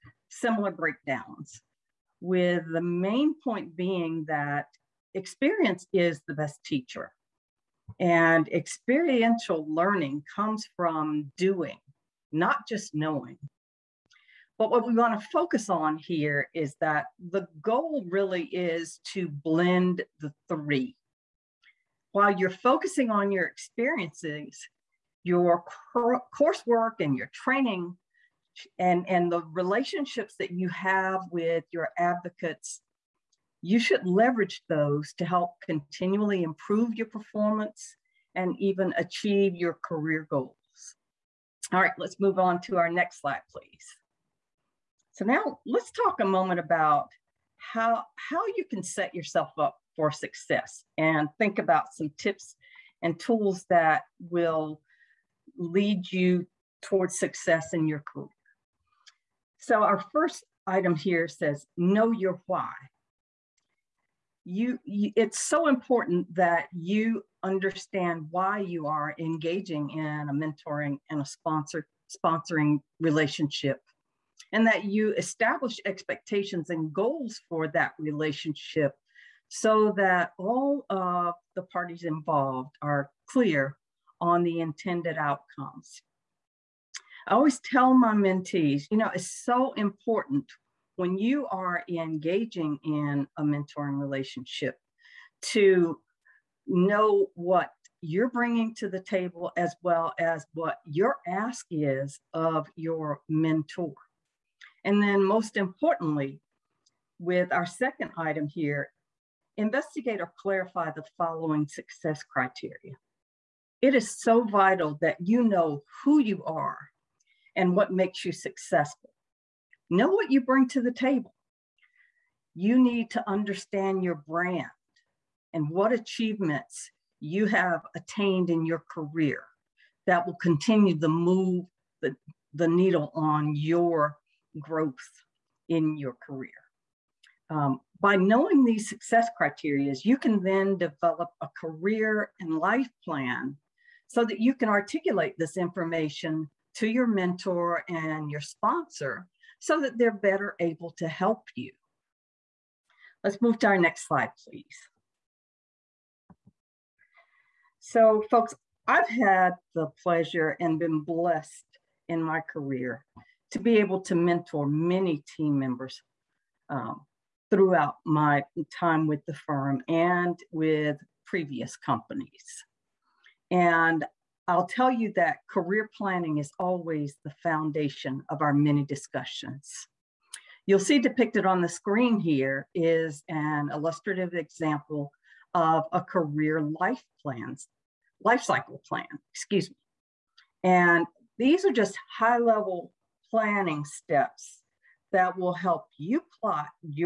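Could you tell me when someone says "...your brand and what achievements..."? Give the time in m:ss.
2:04.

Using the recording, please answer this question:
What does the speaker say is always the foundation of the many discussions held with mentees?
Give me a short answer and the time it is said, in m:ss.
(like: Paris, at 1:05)
Career planning, at 2:55.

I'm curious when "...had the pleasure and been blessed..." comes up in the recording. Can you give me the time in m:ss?
2:39.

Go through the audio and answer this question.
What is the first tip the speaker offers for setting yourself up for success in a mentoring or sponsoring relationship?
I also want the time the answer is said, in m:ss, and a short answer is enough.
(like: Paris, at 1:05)
Know your why, at 1:01.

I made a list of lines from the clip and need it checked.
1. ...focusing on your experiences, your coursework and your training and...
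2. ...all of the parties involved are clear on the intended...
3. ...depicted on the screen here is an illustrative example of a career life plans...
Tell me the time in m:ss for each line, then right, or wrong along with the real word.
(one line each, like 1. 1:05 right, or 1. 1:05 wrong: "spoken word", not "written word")
1. 0:22 right
2. 1:20 right
3. 3:00 right.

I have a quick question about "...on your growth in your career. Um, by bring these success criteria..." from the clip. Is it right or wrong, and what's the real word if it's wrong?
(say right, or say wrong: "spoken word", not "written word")
wrong: "knowing", not "bring".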